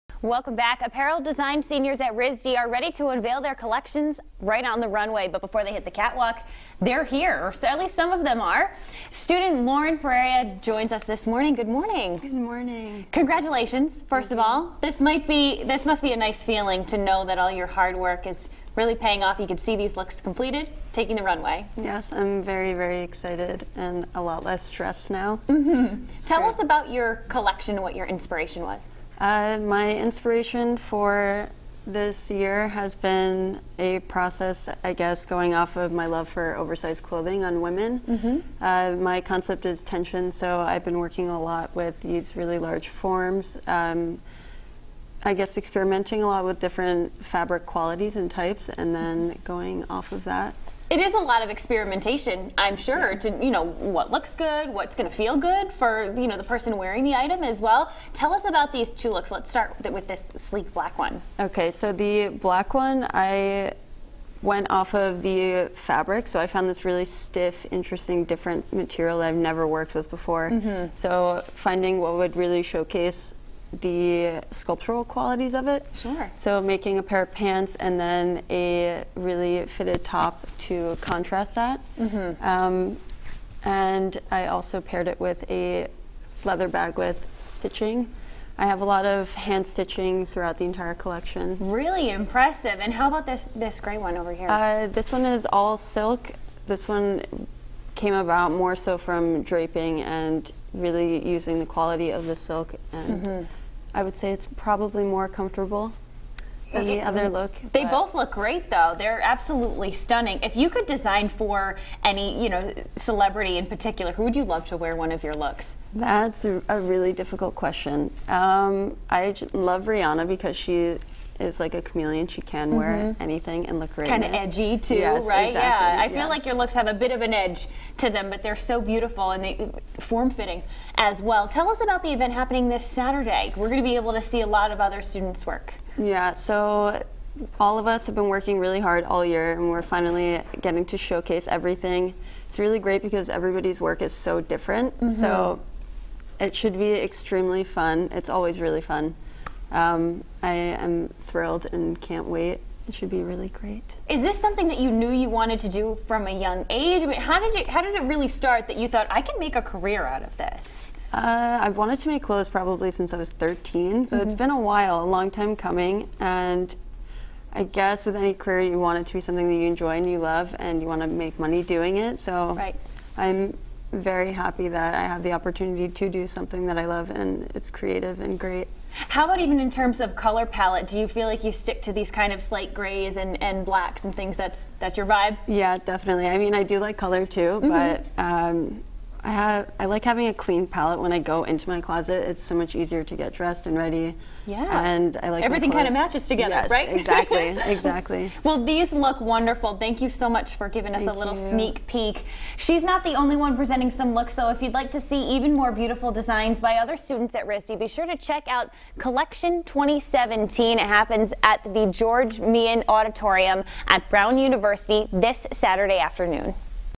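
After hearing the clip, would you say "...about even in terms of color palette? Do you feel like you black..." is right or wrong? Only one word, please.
wrong.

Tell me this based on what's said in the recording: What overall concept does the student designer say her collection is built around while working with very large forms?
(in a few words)
Tension.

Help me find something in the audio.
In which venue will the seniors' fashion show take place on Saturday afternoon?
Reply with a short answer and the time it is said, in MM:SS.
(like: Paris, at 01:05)
George Meehan Auditorium, at 03:31.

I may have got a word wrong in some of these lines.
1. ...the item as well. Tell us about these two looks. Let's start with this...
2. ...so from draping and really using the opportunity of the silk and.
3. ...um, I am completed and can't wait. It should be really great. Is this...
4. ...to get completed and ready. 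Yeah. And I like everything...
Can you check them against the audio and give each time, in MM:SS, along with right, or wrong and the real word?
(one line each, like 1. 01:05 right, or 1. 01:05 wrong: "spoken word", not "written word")
1. 00:57 right
2. 01:38 wrong: "quality", not "opportunity"
3. 02:29 wrong: "thrilled", not "completed"
4. 03:13 wrong: "dressed", not "completed".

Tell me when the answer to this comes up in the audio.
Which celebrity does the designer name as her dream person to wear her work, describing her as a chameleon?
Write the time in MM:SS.
01:59.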